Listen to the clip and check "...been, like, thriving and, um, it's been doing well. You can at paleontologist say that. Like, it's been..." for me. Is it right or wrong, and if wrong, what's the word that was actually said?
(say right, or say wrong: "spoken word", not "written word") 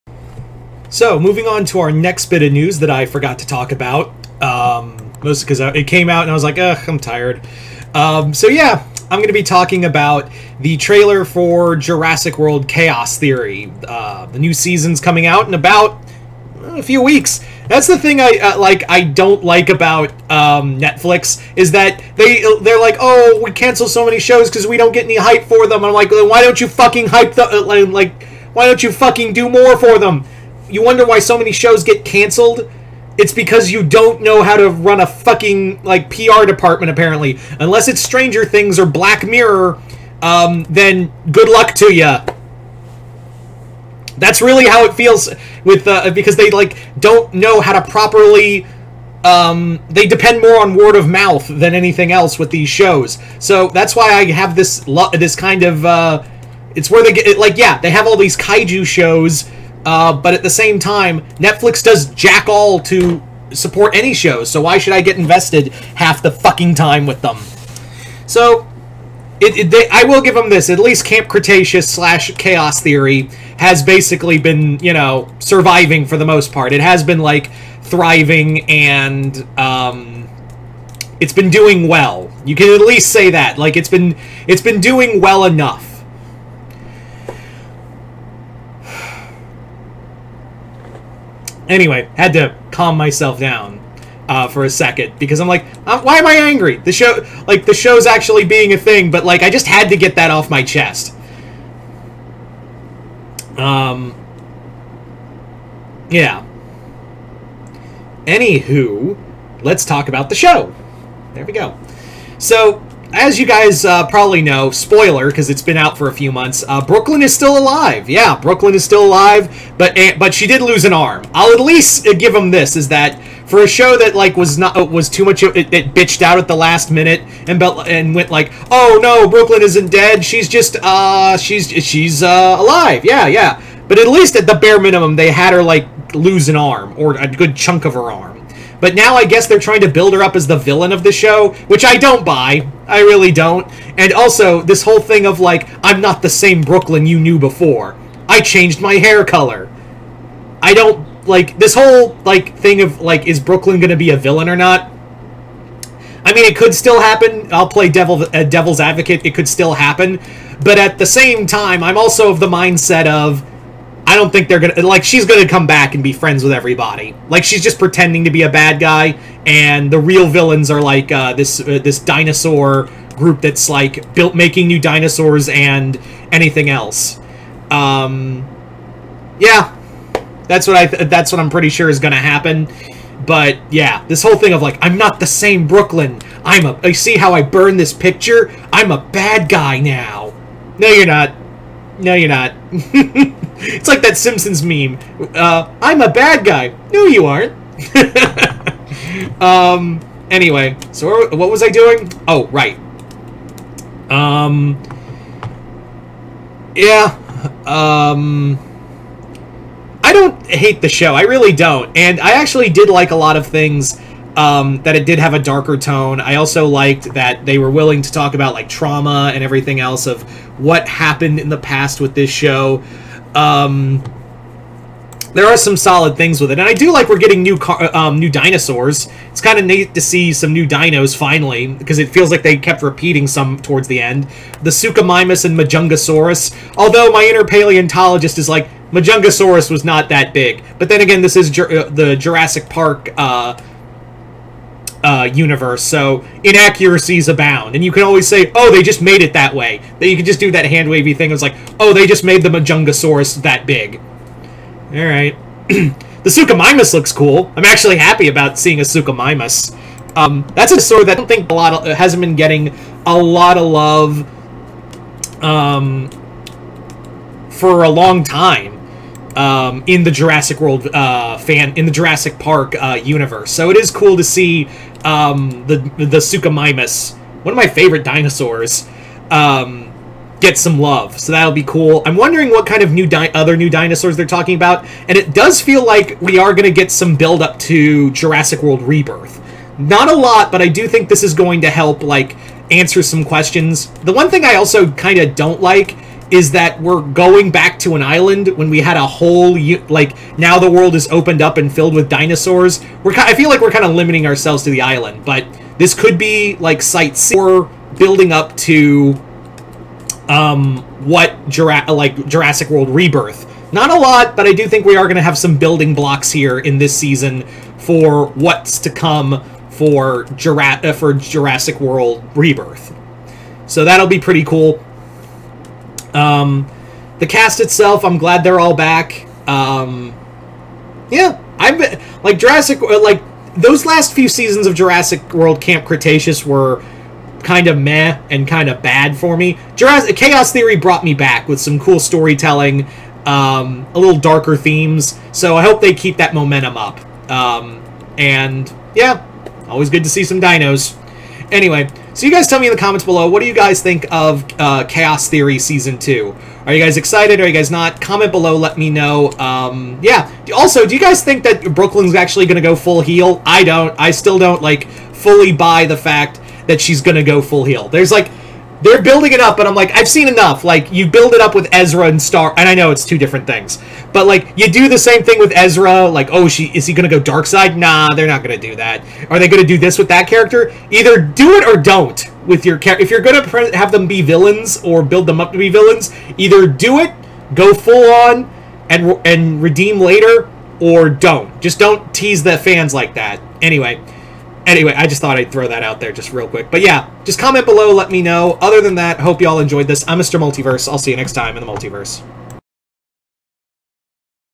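wrong: "least", not "paleontologist".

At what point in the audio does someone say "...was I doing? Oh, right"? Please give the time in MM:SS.
03:21.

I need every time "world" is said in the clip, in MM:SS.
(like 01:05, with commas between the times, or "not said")
00:12, 04:30, 04:48, 05:00, 05:12, 05:21, 05:35.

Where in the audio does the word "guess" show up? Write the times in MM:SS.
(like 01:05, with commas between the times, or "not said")
02:19.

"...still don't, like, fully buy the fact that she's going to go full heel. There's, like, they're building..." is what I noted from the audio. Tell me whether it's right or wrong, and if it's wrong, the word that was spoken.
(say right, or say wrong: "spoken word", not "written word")
right.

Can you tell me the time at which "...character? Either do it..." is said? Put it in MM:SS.
06:20.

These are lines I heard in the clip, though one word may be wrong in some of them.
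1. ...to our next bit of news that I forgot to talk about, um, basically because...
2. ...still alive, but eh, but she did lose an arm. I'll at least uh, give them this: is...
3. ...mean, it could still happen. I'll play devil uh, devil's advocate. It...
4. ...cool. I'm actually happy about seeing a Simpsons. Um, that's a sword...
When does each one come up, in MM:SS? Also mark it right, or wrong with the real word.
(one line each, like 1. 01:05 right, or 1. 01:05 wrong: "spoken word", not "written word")
1. 00:01 wrong: "mostly", not "basically"
2. 01:58 right
3. 02:36 right
4. 04:17 wrong: "Suchomimus", not "Simpsons".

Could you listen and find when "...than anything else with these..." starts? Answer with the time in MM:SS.
00:51.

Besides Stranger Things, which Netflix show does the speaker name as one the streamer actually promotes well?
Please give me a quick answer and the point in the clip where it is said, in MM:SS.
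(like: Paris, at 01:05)
Black Mirror, at 00:38.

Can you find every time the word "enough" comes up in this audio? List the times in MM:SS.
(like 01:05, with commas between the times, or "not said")
01:25, 06:10.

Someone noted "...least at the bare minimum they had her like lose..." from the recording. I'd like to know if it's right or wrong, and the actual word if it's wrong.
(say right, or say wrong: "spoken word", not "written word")
right.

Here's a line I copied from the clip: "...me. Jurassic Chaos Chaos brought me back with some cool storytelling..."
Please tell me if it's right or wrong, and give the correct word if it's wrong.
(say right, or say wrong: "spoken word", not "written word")
wrong: "Theory", not "Chaos".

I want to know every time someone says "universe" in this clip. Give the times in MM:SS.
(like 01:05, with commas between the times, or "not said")
04:05, 04:33.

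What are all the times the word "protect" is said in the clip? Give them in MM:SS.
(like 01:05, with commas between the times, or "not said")
not said.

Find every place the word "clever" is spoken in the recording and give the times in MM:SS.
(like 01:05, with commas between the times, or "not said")
not said.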